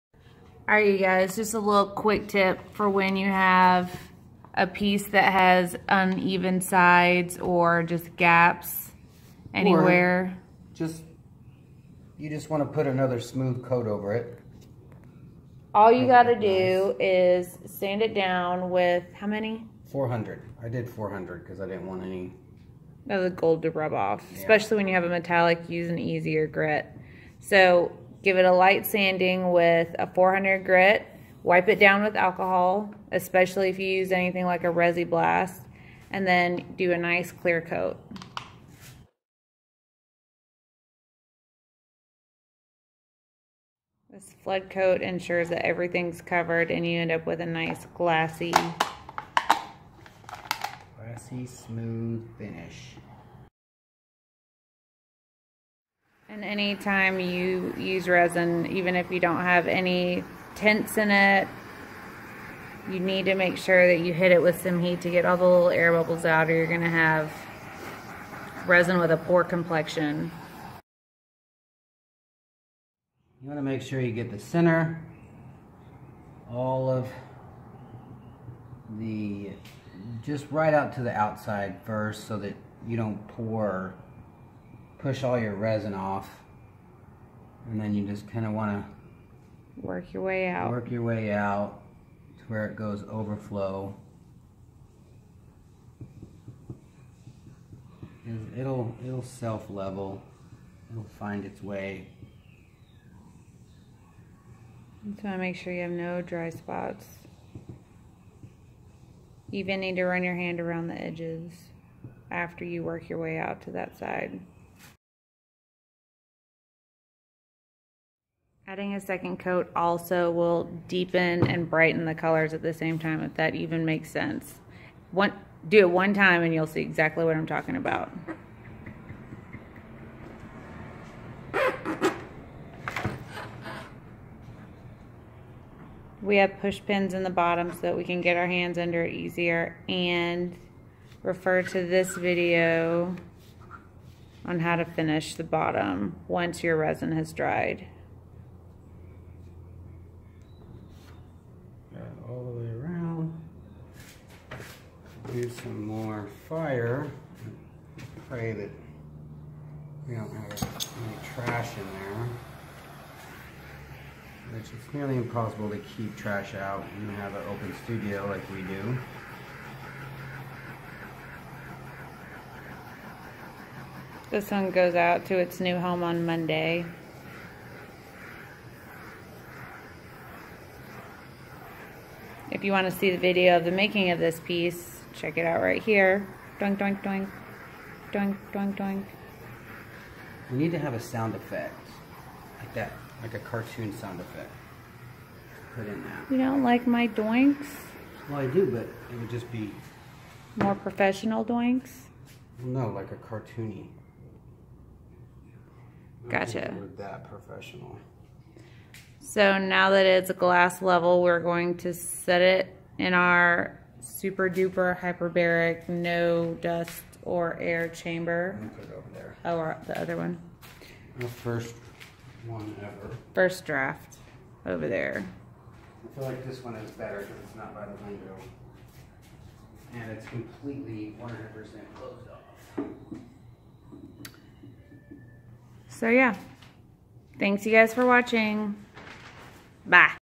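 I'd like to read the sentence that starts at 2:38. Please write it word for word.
Pray that we don't have any trash in there.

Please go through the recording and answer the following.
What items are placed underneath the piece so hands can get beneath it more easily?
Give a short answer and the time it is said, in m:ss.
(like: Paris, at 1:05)
push pins, at 2:16.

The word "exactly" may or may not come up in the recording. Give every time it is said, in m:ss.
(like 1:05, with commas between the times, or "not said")
2:06.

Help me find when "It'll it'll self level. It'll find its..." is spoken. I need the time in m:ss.
1:38.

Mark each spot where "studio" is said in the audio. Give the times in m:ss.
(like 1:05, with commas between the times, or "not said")
2:47.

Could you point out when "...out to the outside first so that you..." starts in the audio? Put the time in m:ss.
1:20.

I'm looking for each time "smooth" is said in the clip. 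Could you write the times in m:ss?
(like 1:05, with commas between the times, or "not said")
0:13, 0:51.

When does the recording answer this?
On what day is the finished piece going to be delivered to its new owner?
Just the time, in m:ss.
2:56.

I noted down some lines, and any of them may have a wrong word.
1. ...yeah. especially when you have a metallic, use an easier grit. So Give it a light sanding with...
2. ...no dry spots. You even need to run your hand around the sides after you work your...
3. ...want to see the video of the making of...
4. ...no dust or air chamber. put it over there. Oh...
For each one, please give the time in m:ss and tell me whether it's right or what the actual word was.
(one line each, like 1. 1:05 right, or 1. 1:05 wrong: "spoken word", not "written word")
1. 0:24 right
2. 1:45 wrong: "edges", not "sides"
3. 3:02 right
4. 3:35 right.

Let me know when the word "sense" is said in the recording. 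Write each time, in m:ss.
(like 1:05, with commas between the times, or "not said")
2:04.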